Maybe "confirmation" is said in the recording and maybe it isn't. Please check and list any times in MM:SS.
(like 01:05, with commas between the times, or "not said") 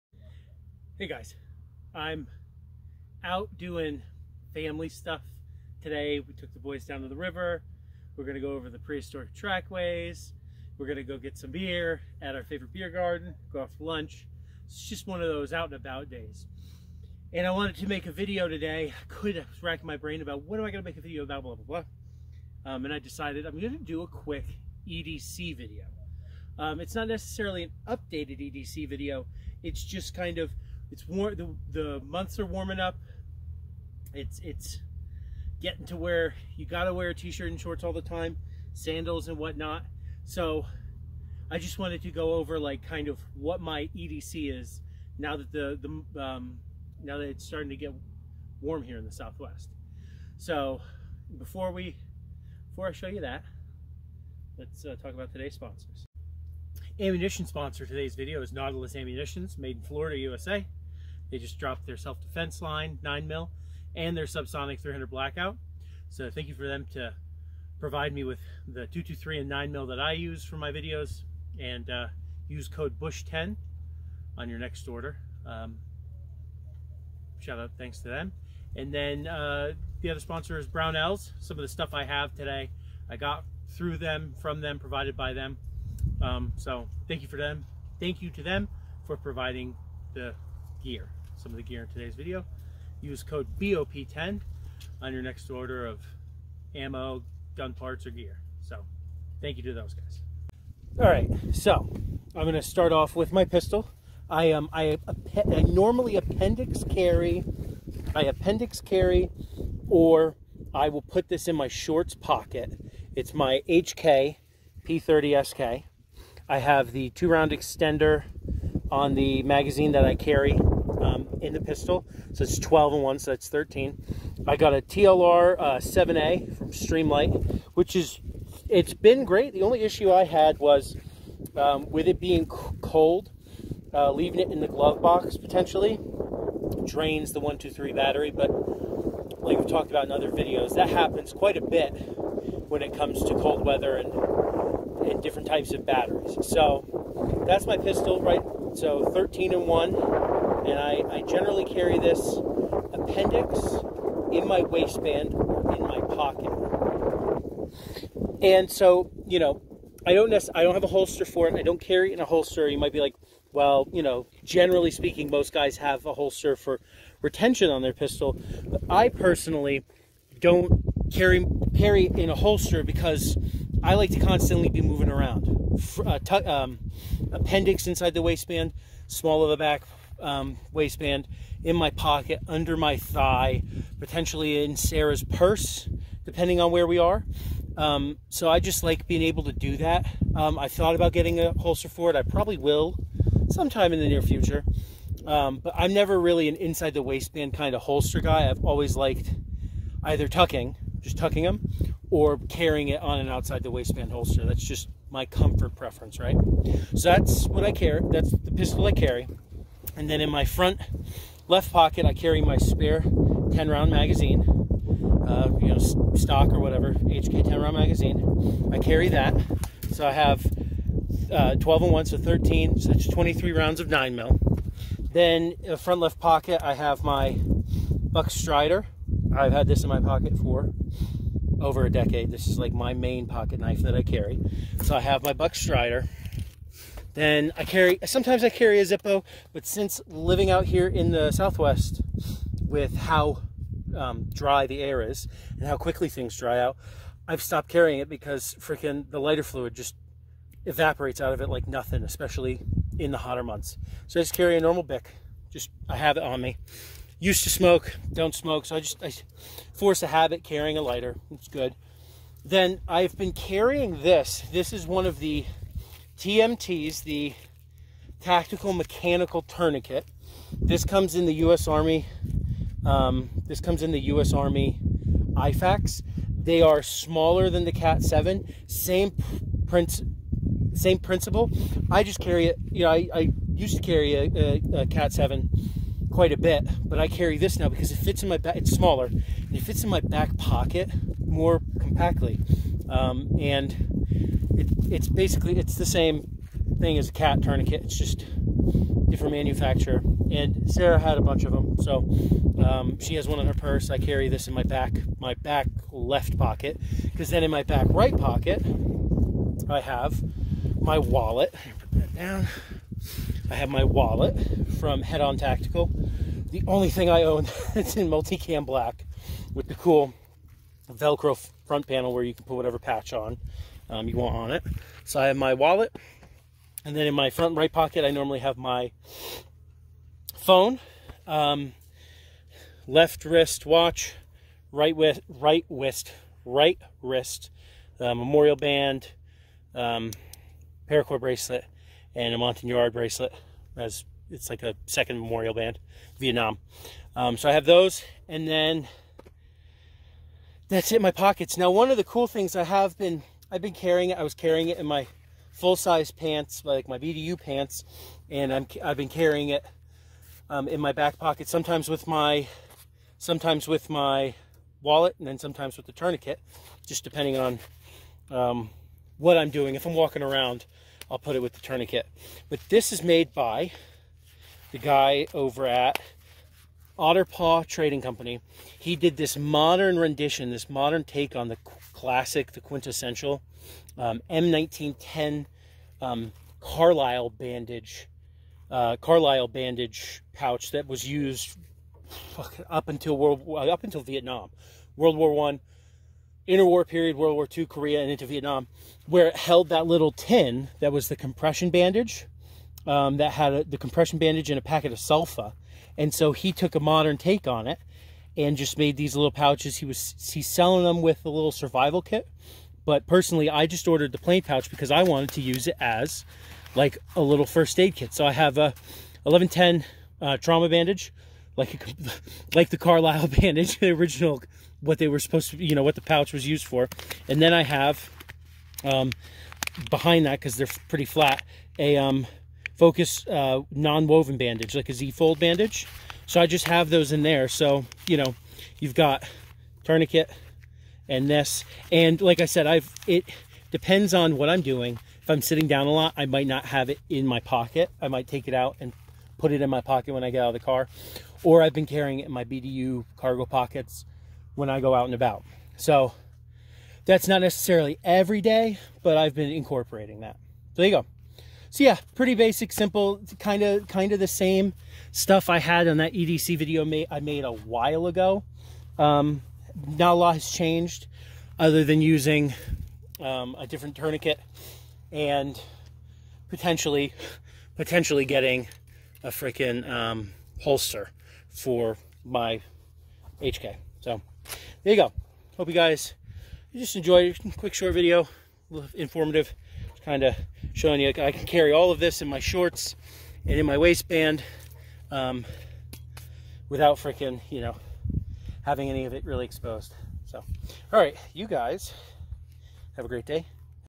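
not said.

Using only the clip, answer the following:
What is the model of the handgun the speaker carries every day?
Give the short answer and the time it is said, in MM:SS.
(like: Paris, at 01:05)
HK P30SK, at 01:53.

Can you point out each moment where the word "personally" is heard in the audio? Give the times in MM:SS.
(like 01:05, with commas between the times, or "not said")
02:49, 06:53.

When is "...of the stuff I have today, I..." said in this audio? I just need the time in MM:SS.
01:21.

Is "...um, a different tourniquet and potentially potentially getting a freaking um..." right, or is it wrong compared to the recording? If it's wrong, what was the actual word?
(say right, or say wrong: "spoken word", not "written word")
right.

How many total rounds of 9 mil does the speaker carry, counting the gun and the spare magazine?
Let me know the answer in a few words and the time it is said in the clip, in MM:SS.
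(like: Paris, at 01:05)
23, at 03:43.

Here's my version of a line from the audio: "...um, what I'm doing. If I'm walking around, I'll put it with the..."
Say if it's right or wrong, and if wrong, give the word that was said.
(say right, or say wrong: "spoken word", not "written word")
right.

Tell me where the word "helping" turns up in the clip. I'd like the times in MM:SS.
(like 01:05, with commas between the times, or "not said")
not said.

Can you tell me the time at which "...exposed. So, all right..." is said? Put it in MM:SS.
08:19.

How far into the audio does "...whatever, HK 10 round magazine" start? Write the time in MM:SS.
03:36.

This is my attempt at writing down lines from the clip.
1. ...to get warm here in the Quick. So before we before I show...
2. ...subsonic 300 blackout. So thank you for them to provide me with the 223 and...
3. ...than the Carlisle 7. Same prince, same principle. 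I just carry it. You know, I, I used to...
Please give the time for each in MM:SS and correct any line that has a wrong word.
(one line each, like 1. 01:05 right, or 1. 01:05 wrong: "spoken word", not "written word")
1. 00:47 wrong: "Southwest", not "Quick"
2. 01:04 right
3. 04:37 wrong: "Cat", not "Carlisle".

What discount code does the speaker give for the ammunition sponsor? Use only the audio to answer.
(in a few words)
BUSH10.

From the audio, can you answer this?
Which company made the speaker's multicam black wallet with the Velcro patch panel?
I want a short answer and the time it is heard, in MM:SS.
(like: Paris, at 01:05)
Head On Tactical, at 05:15.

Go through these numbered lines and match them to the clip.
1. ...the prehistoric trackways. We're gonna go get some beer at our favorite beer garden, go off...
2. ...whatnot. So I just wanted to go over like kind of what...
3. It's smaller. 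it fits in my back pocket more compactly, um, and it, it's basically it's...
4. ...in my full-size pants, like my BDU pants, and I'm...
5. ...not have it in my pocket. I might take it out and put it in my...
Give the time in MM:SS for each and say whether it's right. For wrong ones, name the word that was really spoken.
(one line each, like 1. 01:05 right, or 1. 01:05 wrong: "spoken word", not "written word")
1. 00:08 right
2. 00:39 right
3. 04:48 right
4. 05:54 right
5. 07:26 right.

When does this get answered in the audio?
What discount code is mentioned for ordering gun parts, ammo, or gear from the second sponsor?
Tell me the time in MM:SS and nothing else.
01:33.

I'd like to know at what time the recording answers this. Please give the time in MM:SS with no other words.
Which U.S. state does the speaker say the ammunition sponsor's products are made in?
00:59.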